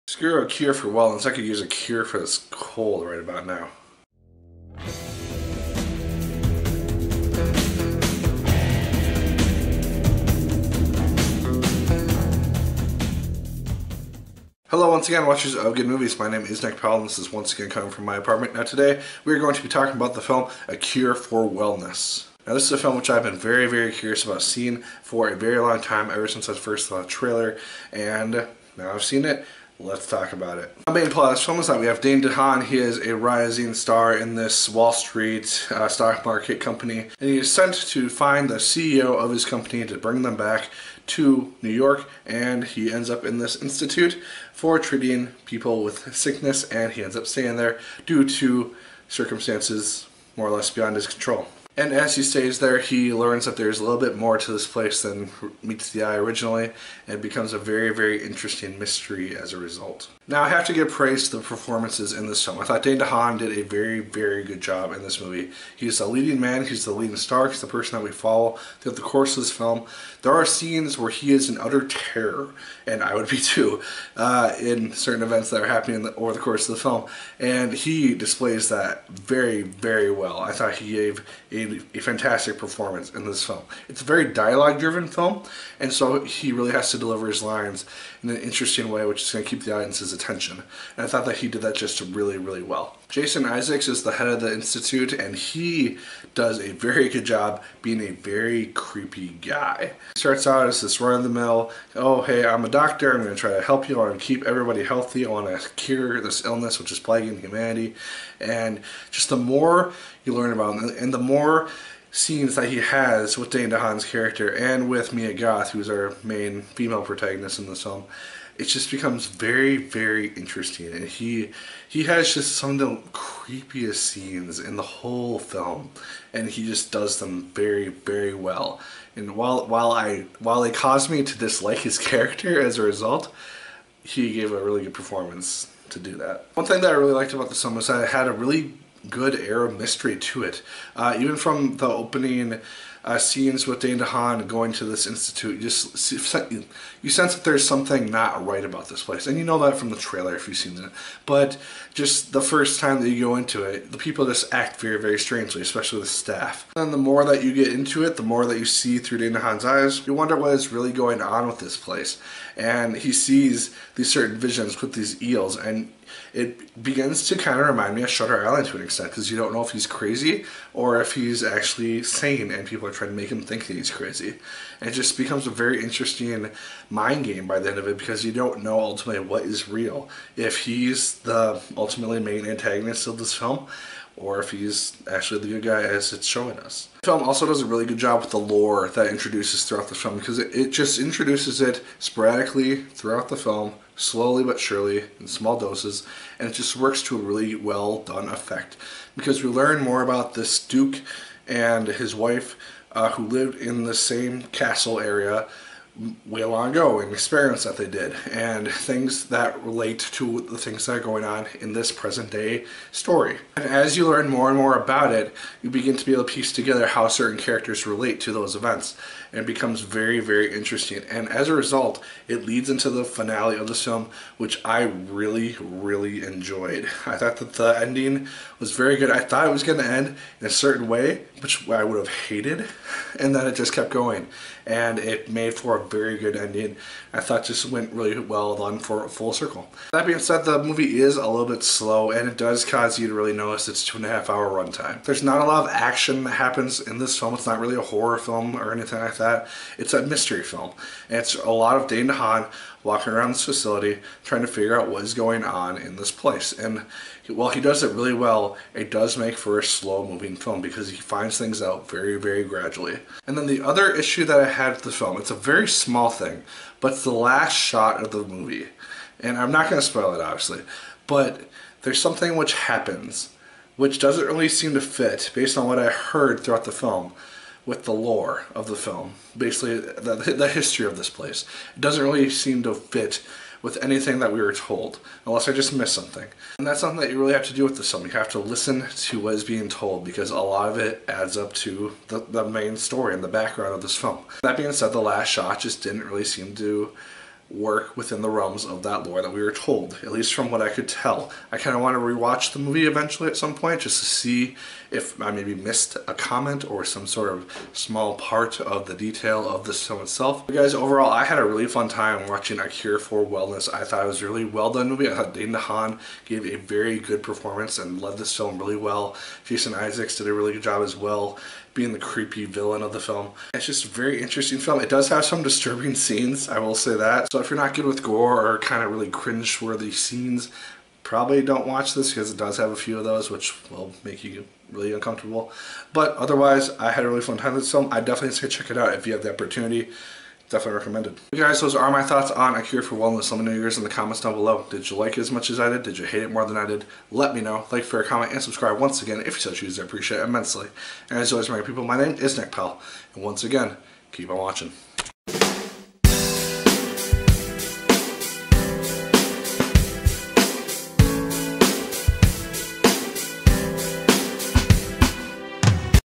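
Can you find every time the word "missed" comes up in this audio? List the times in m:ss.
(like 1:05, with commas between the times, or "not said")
4:45, 5:05.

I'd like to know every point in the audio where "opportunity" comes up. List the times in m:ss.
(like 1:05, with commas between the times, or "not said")
5:39.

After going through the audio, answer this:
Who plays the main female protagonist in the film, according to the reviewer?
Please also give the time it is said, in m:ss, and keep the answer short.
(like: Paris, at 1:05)
Mia Goth, at 1:55.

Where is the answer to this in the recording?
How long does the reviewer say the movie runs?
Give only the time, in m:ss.
4:03.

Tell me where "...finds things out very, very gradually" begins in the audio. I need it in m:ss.
4:20.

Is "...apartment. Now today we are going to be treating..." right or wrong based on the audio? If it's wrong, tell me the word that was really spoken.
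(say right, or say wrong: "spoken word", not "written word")
wrong: "talking", not "treating".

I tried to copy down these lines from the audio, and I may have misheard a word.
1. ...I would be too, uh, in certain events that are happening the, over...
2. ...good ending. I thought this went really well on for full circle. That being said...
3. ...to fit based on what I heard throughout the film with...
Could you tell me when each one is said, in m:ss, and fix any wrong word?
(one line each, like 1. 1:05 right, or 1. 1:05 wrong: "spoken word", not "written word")
1. 1:13 right
2. 3:56 right
3. 4:34 right.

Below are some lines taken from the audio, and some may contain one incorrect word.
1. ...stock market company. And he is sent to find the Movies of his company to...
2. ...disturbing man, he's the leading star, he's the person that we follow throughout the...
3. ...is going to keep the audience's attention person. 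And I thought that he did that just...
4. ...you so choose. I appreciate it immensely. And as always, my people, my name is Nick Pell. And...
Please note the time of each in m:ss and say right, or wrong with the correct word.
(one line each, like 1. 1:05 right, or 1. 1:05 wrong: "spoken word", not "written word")
1. 0:35 wrong: "CEO", not "Movies"
2. 1:06 wrong: "leading", not "disturbing"
3. 1:29 wrong: "attention", not "person"
4. 5:49 right.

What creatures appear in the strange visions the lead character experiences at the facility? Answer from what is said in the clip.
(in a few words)
Eels.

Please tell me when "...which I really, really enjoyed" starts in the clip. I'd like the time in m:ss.
3:44.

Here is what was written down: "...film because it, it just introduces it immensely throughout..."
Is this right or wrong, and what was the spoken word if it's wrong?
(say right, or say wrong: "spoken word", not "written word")
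wrong: "sporadically", not "immensely".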